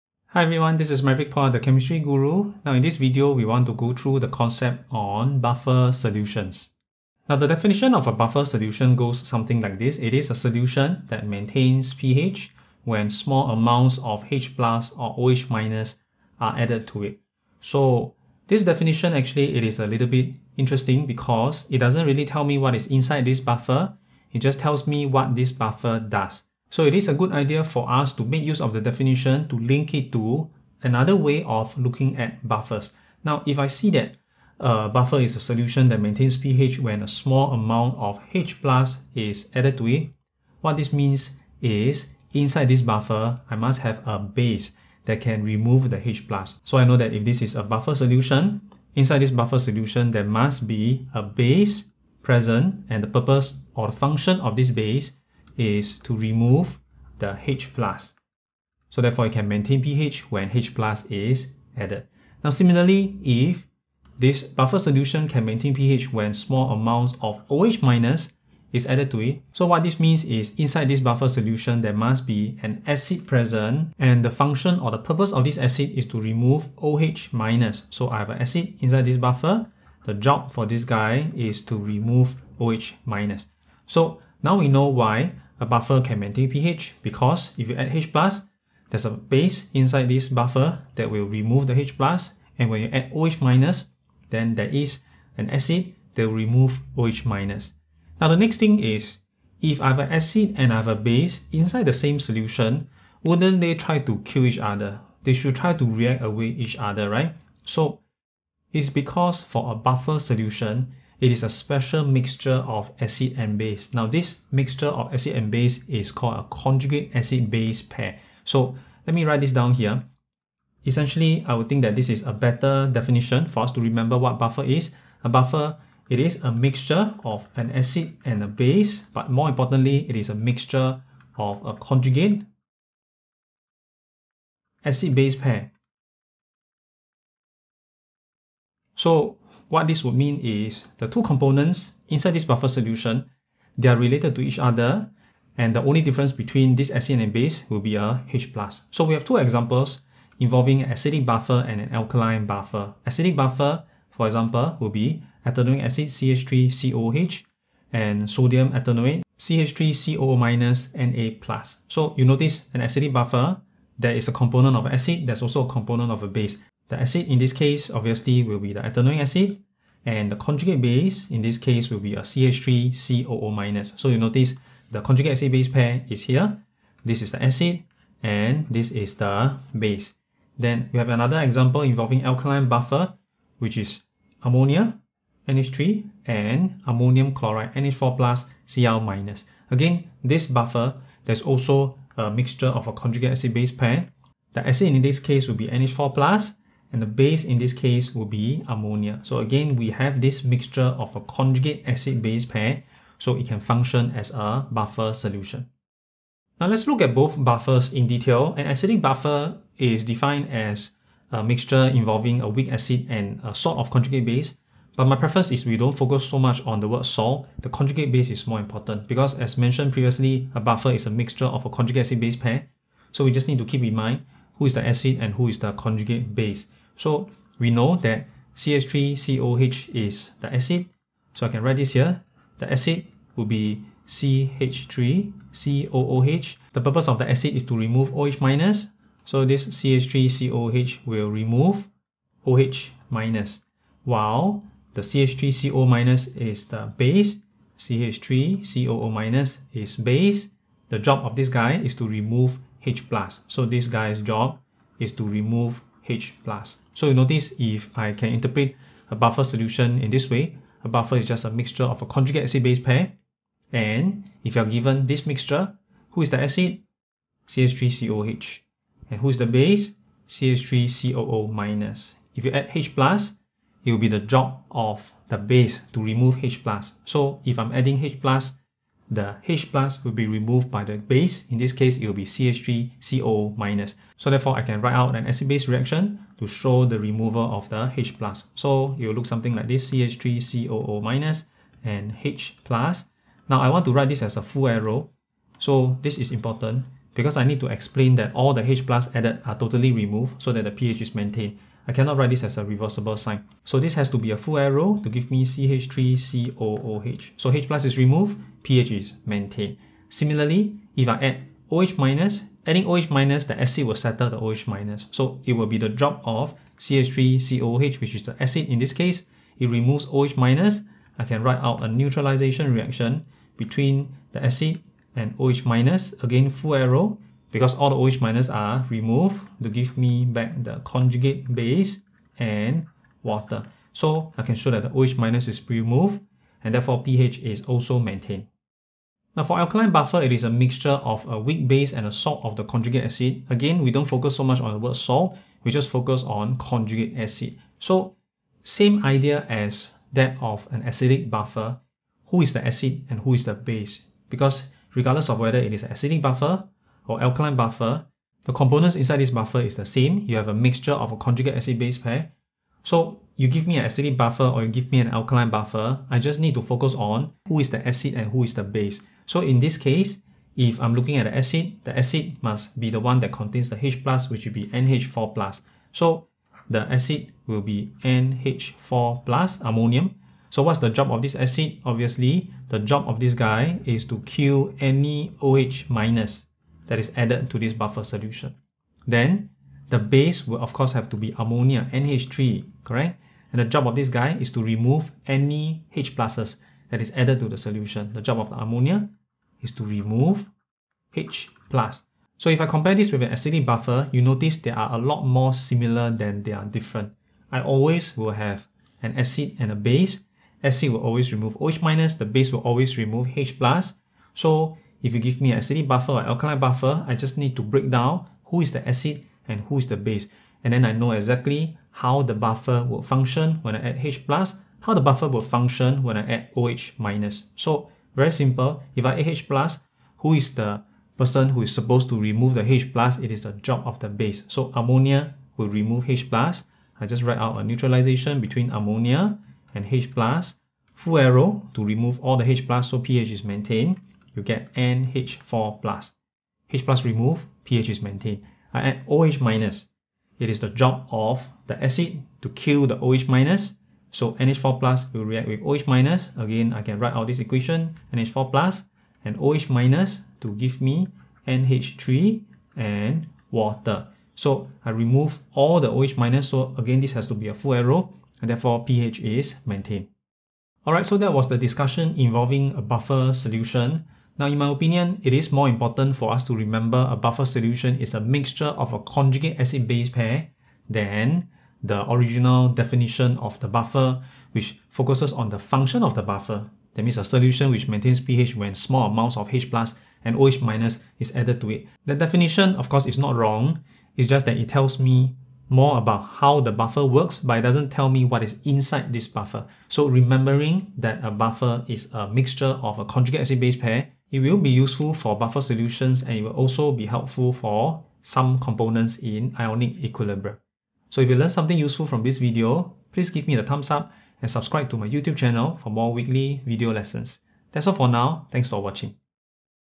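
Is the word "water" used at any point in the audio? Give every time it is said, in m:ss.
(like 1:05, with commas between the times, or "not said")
5:33, 7:43.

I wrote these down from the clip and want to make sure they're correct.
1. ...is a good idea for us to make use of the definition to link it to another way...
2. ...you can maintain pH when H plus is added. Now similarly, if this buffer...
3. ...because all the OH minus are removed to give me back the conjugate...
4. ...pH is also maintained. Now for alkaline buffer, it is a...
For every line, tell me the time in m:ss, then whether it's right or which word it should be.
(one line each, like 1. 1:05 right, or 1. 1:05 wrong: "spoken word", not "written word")
1. 0:26 right
2. 0:59 right
3. 5:27 right
4. 5:37 right.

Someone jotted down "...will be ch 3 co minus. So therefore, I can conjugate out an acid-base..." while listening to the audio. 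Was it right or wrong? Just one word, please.
wrong.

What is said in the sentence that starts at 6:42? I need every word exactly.
So if I compare this with an acidic buffer, you notice they are a lot more similar than they are different.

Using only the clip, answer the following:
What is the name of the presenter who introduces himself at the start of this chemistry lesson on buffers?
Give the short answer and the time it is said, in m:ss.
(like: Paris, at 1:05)
Maverick Puah, at 0:01.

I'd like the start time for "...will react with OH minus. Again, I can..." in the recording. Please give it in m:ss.
7:35.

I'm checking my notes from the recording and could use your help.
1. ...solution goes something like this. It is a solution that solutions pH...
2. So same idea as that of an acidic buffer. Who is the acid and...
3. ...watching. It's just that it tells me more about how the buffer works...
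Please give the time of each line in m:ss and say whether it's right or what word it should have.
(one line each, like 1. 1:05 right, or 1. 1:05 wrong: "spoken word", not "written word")
1. 0:08 wrong: "maintains", not "solutions"
2. 5:47 right
3. 8:13 wrong: "wrong", not "watching".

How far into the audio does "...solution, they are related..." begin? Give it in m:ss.
2:22.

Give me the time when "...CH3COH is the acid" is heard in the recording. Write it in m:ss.
3:48.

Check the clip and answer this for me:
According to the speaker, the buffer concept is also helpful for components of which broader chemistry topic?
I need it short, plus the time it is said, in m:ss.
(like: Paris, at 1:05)
ionic equilibrium, at 8:29.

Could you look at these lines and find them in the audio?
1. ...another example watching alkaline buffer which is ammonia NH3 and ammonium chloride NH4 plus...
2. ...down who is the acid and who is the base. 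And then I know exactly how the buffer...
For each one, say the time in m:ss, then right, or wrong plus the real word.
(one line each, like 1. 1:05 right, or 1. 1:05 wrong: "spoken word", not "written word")
1. 3:01 wrong: "involving", not "watching"
2. 6:57 right.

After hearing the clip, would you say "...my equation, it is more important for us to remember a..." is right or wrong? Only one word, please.
wrong.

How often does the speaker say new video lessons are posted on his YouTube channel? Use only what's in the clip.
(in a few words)
weekly.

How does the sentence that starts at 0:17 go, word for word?
So this definition actually it is a little bit interesting because it doesn't really tell me what is inside this buffer.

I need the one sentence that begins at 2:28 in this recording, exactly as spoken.
So we have two examples involving an acidic buffer and an alkaline buffer.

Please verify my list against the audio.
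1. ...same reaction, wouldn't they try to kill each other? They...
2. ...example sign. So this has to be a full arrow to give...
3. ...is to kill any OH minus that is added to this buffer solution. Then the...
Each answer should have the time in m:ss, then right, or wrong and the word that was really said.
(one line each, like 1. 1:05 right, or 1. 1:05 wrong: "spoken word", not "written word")
1. 1:41 wrong: "solution", not "reaction"
2. 5:02 wrong: "reversible", not "example"
3. 6:23 right.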